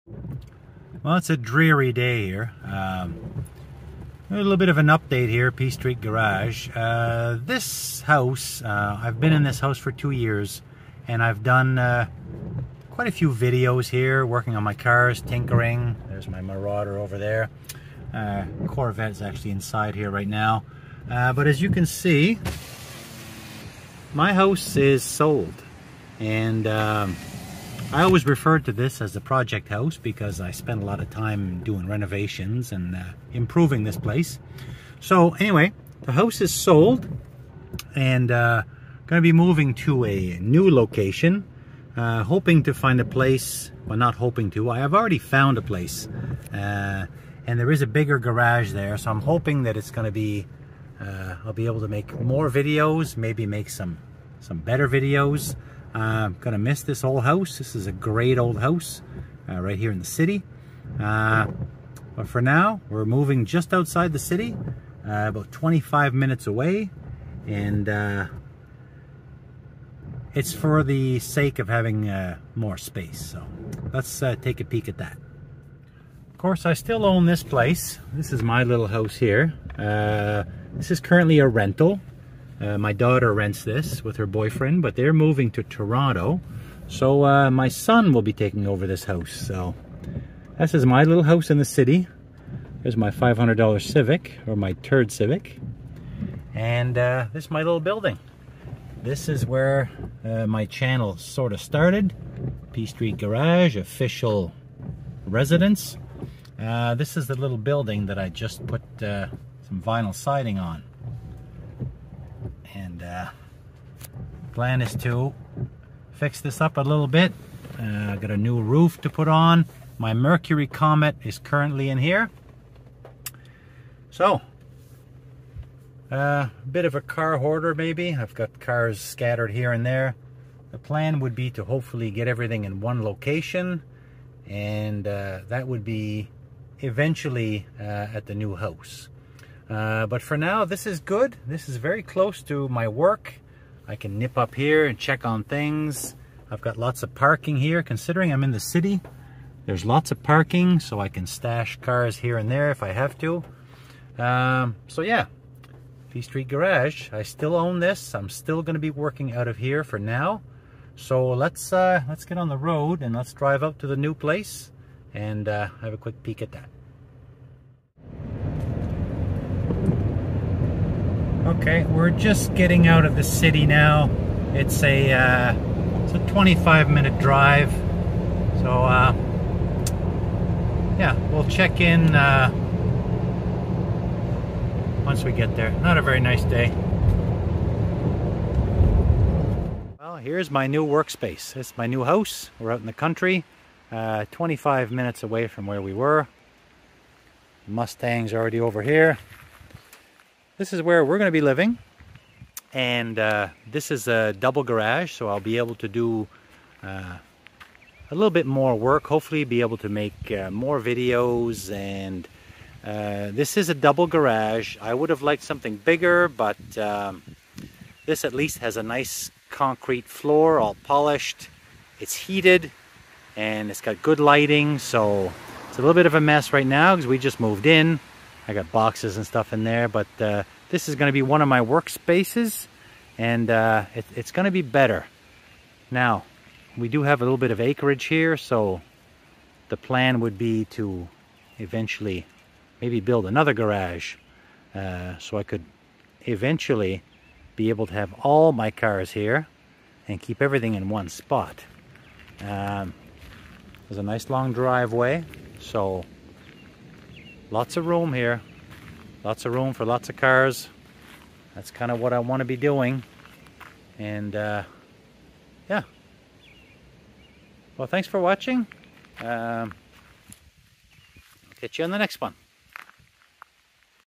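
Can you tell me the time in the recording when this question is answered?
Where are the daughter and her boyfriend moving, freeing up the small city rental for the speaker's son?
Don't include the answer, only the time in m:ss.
1:25.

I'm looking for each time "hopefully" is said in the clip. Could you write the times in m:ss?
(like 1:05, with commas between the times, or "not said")
2:11, 3:29.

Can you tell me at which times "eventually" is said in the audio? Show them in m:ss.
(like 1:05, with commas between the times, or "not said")
2:16, 4:01, 4:06.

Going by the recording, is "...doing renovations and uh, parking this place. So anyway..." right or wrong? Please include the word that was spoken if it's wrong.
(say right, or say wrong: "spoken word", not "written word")
wrong: "improving", not "parking".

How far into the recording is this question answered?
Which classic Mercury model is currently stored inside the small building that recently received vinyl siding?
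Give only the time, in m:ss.
2:00.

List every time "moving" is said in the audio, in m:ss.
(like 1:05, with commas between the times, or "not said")
0:39, 1:03, 1:25.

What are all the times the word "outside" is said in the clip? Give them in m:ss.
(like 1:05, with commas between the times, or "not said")
1:03.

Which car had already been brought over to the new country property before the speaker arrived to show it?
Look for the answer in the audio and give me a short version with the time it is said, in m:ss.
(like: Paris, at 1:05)
Mustang, at 3:17.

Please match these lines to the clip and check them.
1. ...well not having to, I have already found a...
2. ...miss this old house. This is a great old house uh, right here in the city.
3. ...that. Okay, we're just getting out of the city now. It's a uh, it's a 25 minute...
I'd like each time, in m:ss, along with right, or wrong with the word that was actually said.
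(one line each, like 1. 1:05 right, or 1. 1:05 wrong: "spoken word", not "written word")
1. 0:43 wrong: "hoping", not "having"
2. 0:56 right
3. 2:46 right.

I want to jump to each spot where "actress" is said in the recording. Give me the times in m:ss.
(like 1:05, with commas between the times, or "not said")
not said.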